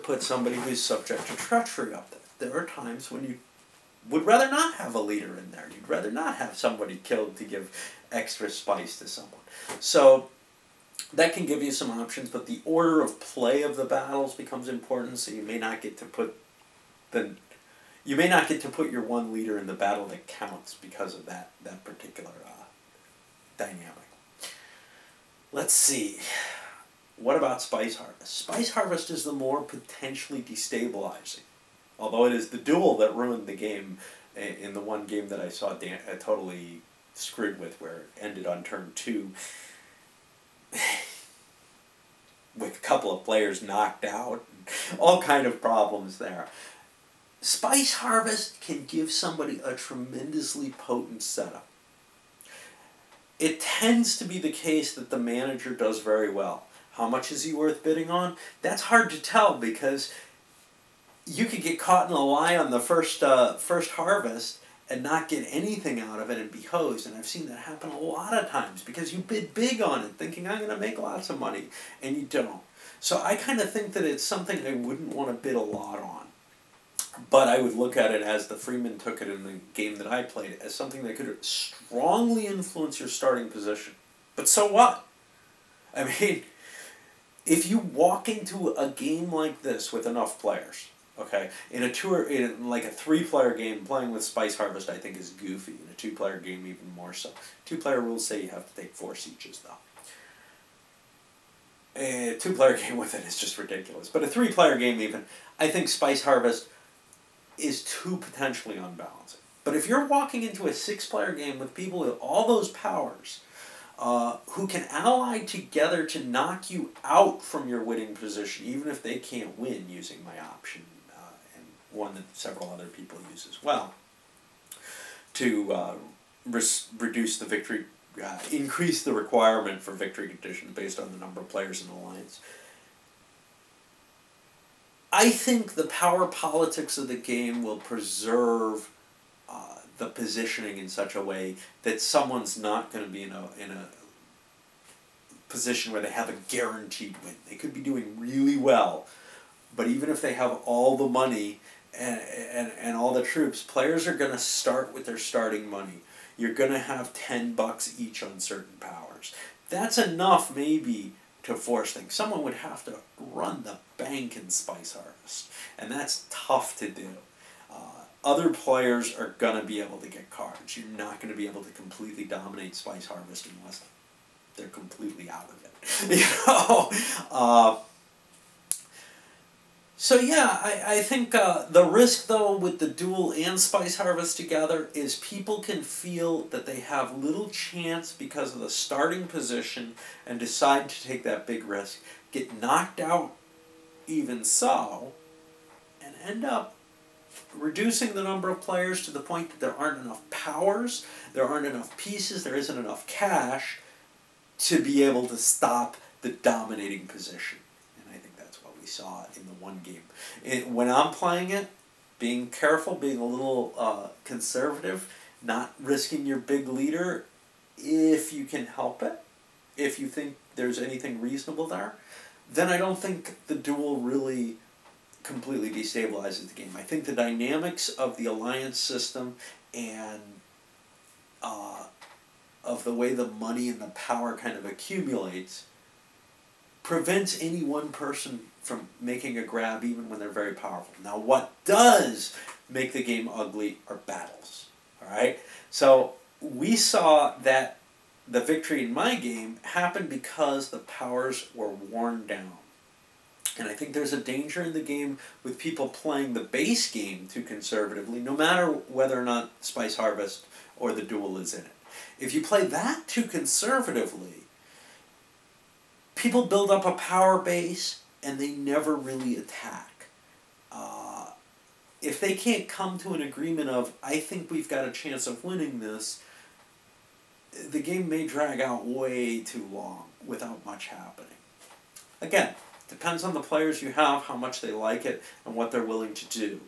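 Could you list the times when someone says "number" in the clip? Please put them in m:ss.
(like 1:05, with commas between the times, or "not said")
2:11, 3:18.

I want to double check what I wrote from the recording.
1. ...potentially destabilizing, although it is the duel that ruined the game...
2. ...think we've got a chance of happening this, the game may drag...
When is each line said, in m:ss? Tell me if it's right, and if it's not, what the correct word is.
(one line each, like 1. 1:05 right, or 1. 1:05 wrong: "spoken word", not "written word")
1. 0:29 right
2. 4:34 wrong: "winning", not "happening".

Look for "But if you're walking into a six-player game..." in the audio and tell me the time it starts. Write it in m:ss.
1:49.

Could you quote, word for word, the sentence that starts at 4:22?
If you play that too conservatively, people build up a power base and they never really attack.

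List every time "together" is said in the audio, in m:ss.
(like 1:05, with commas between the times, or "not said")
1:55, 3:04.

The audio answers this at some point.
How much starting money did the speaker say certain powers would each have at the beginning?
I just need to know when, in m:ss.
2:37.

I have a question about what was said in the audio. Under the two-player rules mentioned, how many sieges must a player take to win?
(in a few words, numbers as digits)
4.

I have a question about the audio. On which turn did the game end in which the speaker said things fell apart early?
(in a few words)
Turn 2.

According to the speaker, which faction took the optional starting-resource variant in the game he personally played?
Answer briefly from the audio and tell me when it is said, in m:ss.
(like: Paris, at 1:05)
Fremen, at 1:18.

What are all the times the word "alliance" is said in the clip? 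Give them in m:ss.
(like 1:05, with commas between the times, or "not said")
2:11, 3:48.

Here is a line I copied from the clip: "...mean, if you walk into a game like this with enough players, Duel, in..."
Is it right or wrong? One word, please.
wrong.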